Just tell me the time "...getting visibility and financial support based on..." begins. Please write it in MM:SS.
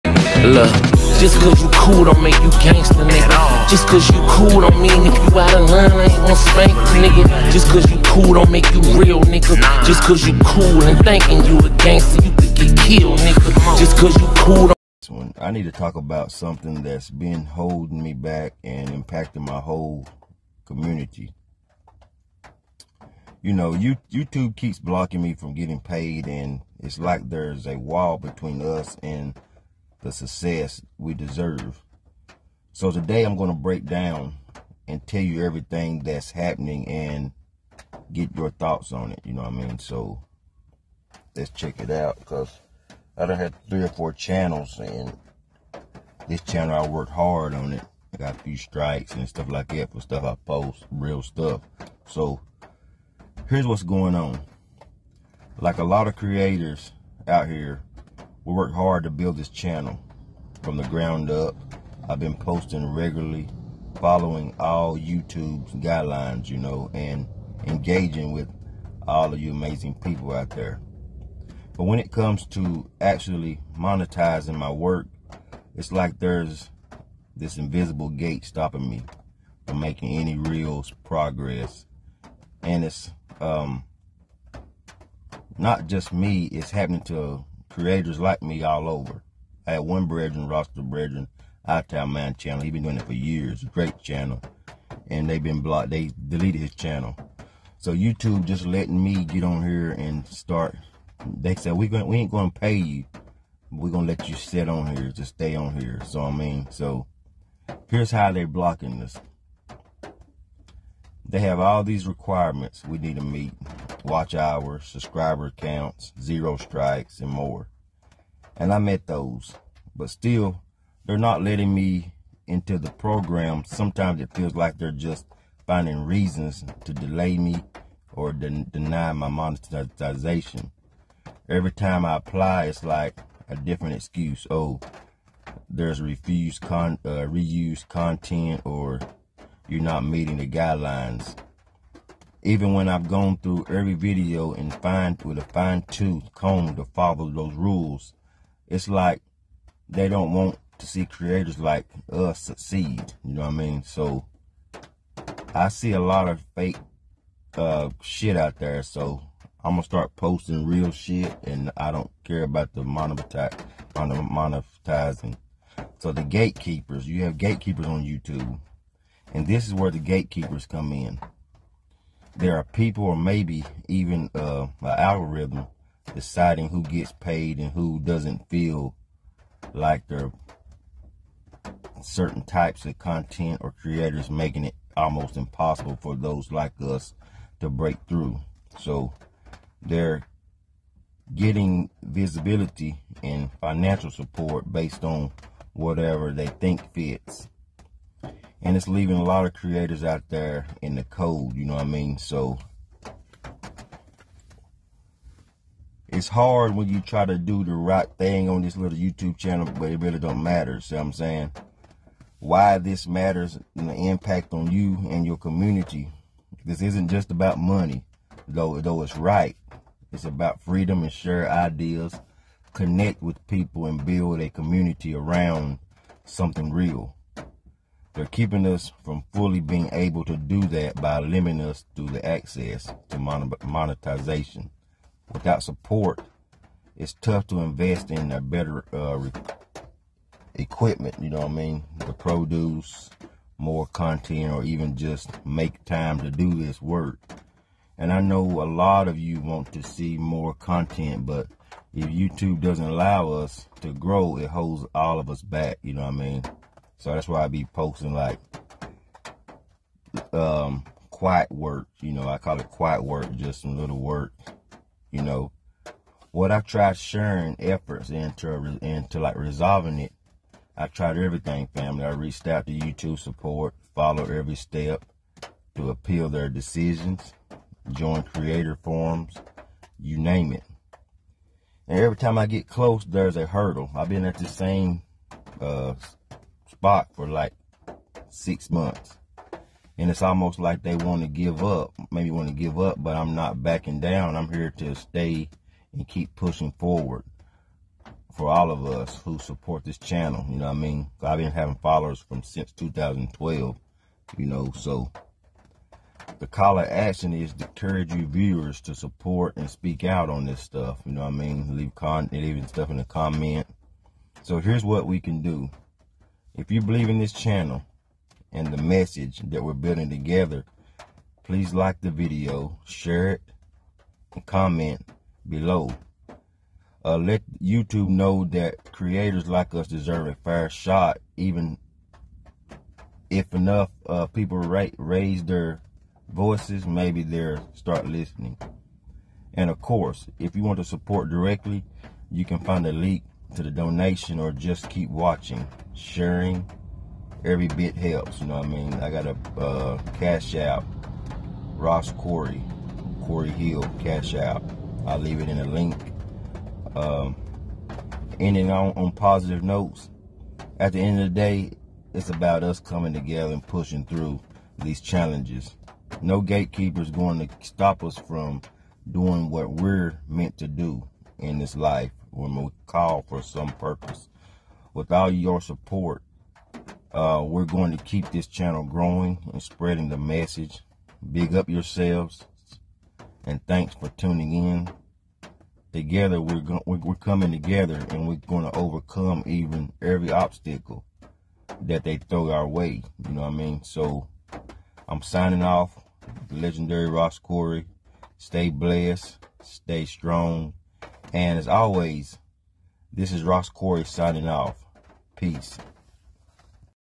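03:11.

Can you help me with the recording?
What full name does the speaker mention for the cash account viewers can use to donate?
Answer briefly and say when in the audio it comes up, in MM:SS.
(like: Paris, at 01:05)
Corey Hill, at 05:53.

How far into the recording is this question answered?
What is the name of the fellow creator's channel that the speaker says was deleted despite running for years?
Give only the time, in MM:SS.
01:31.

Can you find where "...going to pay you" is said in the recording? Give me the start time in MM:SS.
01:42.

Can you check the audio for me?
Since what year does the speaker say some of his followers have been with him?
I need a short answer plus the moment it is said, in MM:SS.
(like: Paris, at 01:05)
2012, at 05:02.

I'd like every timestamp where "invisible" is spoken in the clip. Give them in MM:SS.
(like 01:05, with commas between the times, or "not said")
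01:17.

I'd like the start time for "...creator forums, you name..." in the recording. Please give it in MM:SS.
04:38.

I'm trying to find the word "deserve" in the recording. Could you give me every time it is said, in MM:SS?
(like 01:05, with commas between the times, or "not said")
00:31, 05:29.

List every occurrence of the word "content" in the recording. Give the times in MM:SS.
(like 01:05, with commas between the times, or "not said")
02:17, 03:02, 04:03, 04:10.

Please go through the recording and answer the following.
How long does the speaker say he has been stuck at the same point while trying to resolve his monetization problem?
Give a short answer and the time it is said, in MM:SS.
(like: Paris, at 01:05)
Six months, at 04:48.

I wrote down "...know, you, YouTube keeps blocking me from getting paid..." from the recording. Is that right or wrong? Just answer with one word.
right.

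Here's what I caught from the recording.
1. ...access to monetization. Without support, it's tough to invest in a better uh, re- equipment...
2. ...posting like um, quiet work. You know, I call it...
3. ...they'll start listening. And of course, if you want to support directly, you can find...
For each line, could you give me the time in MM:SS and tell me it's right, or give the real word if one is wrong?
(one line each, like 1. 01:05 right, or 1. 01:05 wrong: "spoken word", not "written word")
1. 03:52 right
2. 04:17 right
3. 05:37 right.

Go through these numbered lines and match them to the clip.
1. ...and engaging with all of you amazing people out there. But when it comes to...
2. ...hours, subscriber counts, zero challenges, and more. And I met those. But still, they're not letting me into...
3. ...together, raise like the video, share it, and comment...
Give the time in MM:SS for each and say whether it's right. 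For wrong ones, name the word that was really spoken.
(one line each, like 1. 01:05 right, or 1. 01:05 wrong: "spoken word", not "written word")
1. 01:06 right
2. 01:54 wrong: "strikes", not "challenges"
3. 05:20 wrong: "please", not "raise".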